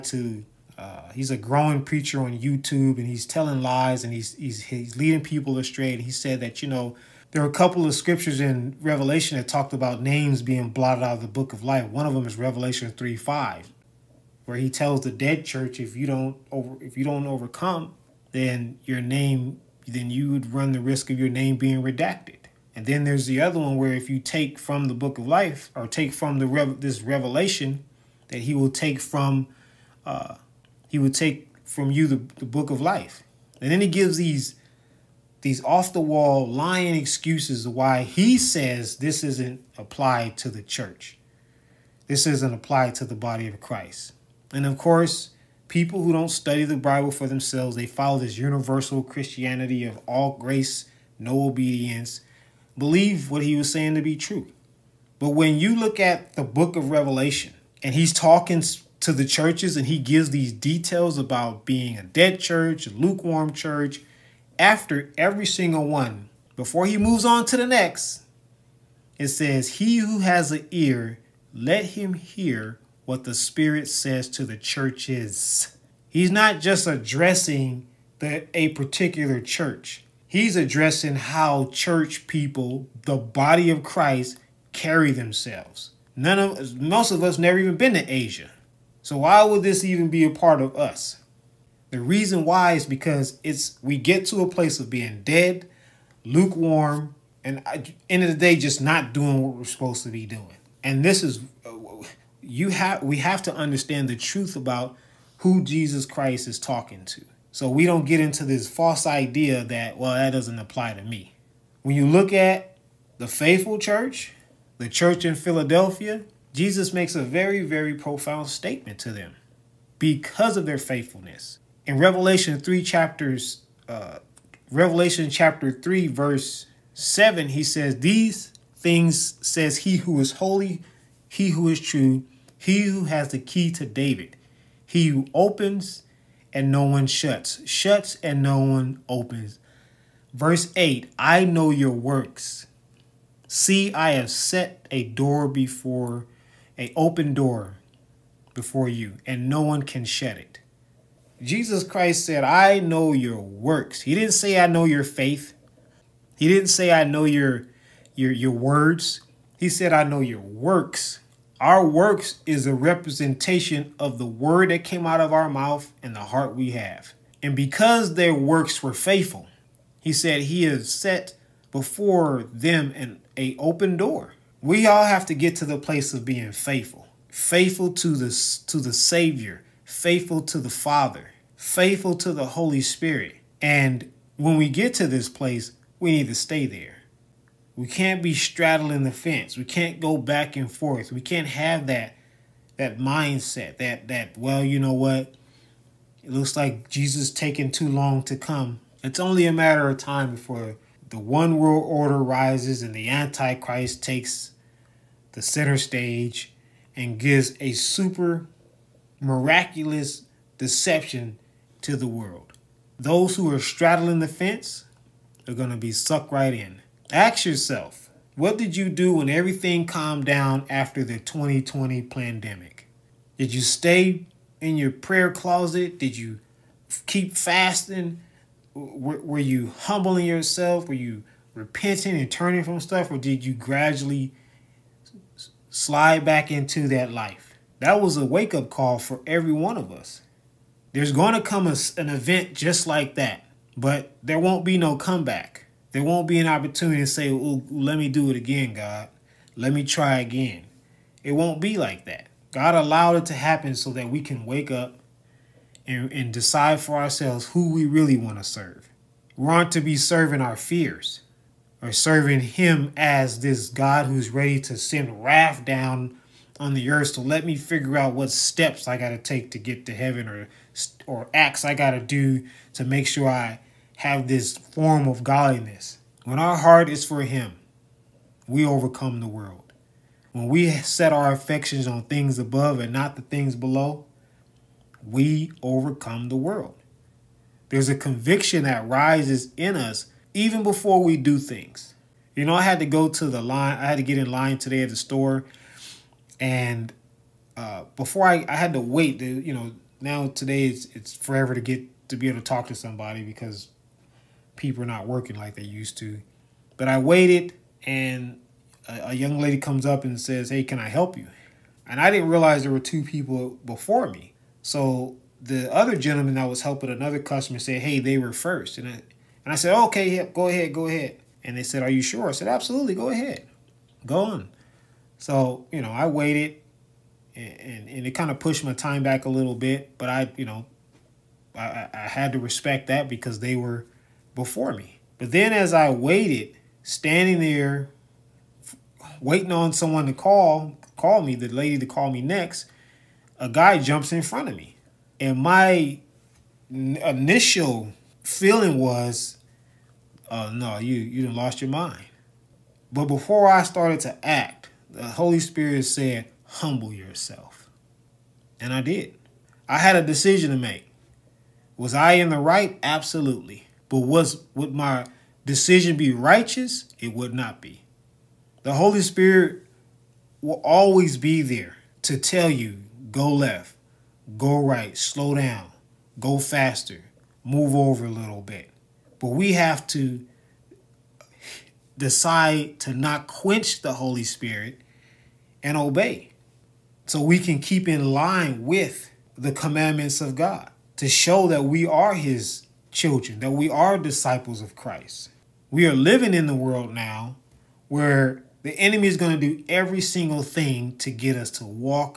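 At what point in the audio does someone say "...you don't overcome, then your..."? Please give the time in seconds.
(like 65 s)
16 s.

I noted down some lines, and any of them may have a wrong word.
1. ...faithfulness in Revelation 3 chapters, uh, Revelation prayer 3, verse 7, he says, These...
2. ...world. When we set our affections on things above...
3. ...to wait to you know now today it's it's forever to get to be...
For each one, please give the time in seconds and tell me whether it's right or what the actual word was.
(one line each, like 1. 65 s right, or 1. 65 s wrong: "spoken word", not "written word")
1. 120 s wrong: "chapter", not "prayer"
2. 279 s right
3. 298 s right.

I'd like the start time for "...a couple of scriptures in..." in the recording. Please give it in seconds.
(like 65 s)
7 s.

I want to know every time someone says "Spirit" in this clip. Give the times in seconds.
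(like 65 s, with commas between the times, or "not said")
73 s, 182 s, 355 s, 369 s, 384 s.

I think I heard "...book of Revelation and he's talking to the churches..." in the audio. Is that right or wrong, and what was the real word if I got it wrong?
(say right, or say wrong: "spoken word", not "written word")
right.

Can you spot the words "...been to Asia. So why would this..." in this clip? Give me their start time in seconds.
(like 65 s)
87 s.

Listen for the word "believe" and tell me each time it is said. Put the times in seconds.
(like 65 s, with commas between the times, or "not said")
52 s.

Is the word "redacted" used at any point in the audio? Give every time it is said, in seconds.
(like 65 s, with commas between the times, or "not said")
21 s.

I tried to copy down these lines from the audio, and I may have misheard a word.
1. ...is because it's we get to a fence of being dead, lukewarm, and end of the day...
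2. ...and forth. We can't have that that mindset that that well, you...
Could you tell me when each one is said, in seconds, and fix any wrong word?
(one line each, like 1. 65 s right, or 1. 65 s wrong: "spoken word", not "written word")
1. 92 s wrong: "place", not "fence"
2. 190 s right.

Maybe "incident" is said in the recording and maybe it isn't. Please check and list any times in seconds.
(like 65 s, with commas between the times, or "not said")
not said.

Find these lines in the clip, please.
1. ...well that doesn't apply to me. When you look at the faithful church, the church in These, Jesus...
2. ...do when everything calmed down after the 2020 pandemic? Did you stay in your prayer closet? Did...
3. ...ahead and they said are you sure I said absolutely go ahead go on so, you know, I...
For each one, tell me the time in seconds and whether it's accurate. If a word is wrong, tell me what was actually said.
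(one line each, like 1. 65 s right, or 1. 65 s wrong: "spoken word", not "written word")
1. 109 s wrong: "Philadelphia", not "These"
2. 218 s right
3. 320 s right.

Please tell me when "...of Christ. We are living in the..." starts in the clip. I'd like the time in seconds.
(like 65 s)
394 s.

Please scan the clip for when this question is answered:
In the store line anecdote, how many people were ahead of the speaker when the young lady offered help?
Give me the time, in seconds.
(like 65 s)
312 s.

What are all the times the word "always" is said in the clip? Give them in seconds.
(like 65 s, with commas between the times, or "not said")
370 s.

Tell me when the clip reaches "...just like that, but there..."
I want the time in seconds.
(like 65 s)
242 s.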